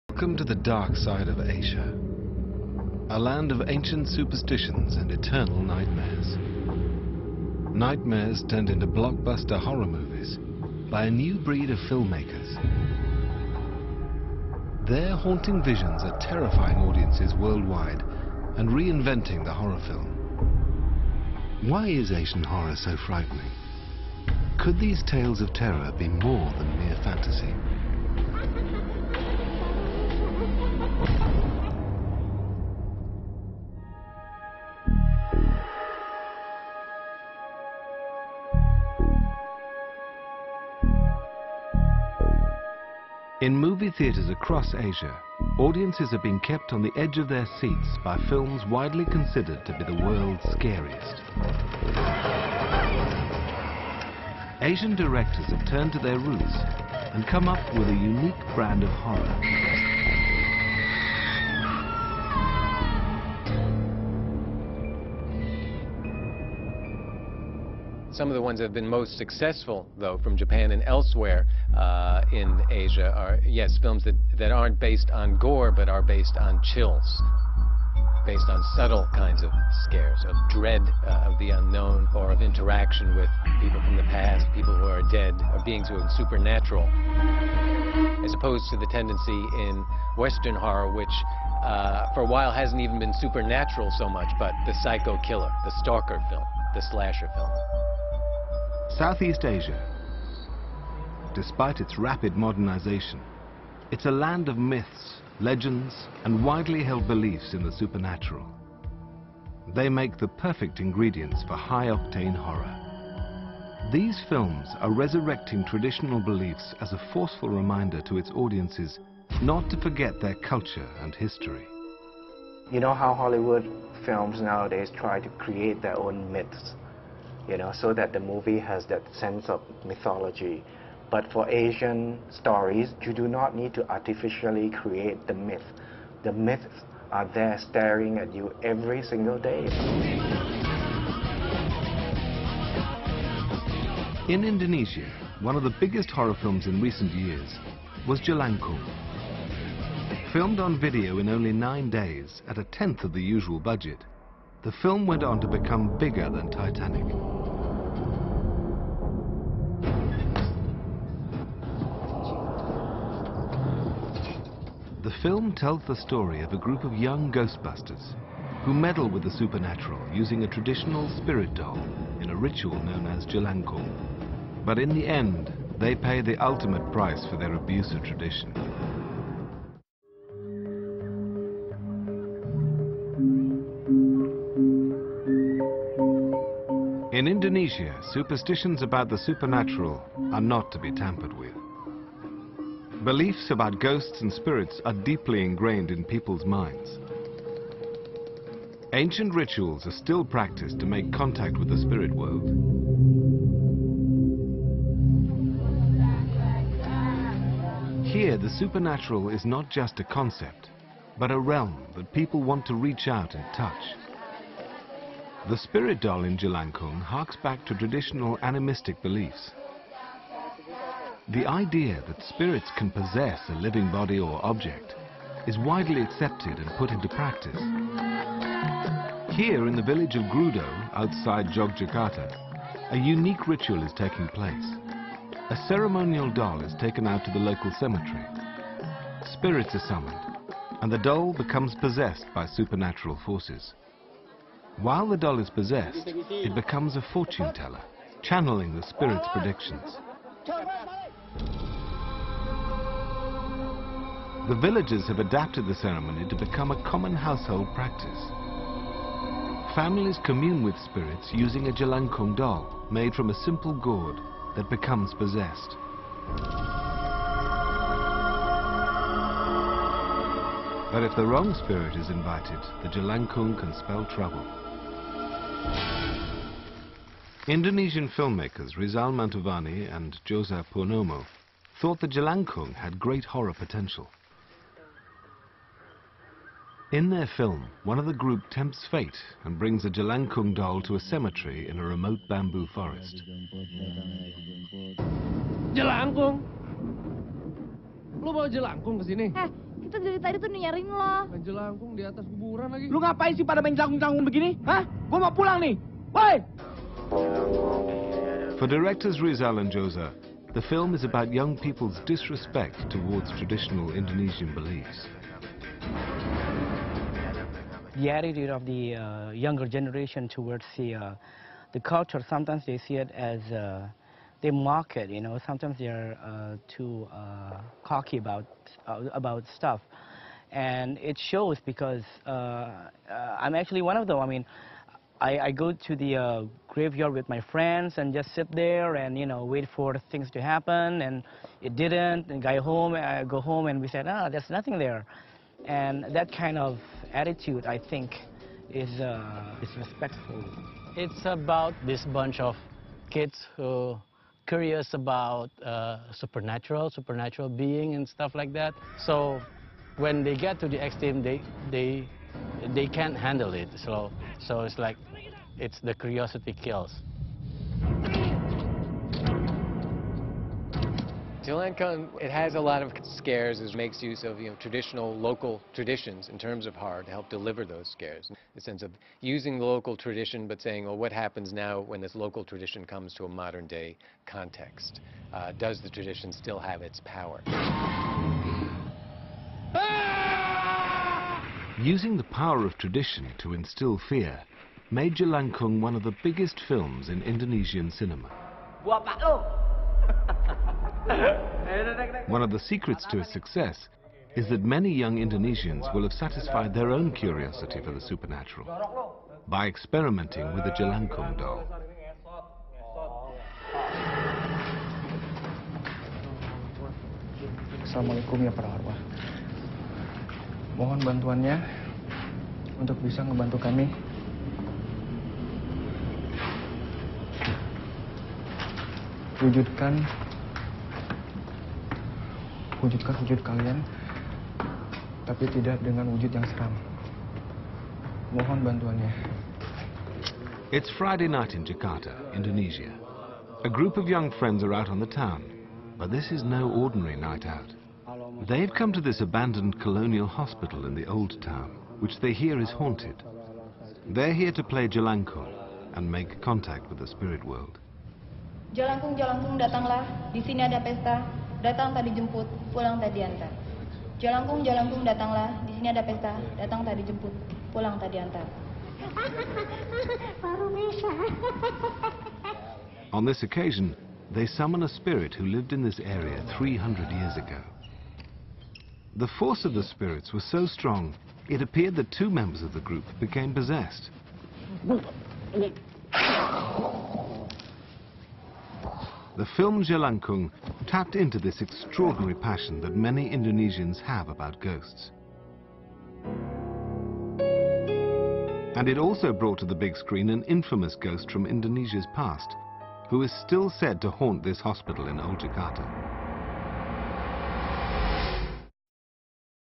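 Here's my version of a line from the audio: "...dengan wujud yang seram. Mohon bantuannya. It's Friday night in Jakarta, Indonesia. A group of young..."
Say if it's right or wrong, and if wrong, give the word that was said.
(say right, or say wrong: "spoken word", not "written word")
right.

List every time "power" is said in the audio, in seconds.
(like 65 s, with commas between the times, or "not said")
387 s, 392 s.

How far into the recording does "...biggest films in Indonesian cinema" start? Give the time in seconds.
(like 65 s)
396 s.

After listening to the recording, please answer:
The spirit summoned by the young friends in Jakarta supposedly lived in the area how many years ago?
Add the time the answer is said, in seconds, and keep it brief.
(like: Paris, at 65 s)
300, at 476 s.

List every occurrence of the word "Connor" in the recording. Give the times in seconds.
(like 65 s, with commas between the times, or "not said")
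not said.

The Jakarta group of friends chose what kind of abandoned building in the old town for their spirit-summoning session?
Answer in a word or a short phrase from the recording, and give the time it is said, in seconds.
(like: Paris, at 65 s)
Colonial hospital, at 449 s.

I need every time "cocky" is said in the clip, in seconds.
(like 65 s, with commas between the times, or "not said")
327 s.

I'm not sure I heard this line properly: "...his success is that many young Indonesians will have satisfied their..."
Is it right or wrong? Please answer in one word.
right.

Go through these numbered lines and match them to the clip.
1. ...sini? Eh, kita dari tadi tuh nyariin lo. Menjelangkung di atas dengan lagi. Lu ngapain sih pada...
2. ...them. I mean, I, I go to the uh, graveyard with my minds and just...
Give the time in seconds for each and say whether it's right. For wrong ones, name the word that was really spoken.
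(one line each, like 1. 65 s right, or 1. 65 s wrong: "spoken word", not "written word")
1. 299 s wrong: "kuburan", not "dengan"
2. 334 s wrong: "friends", not "minds".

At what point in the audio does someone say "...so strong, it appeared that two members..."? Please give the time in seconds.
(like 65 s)
480 s.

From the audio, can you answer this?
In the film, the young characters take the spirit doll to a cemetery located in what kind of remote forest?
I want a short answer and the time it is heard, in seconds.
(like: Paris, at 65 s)
Bamboo forest, at 292 s.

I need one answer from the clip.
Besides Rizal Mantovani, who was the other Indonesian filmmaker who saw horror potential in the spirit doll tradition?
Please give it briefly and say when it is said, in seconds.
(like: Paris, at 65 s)
Jose Purnomo, at 280 s.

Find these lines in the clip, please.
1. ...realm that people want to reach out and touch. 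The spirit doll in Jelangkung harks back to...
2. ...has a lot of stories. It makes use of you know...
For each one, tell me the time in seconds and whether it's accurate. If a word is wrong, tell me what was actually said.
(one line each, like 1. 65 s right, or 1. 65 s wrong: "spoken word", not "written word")
1. 211 s right
2. 372 s wrong: "scares", not "stories".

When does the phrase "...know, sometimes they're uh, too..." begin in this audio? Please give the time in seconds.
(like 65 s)
325 s.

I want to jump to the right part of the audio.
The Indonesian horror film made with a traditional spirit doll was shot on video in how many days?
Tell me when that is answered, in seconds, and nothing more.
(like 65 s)
151 s.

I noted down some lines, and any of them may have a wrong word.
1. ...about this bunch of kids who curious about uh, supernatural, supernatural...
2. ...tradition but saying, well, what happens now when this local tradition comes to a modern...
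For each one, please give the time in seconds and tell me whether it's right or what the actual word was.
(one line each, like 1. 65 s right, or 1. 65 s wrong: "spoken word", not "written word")
1. 351 s right
2. 379 s right.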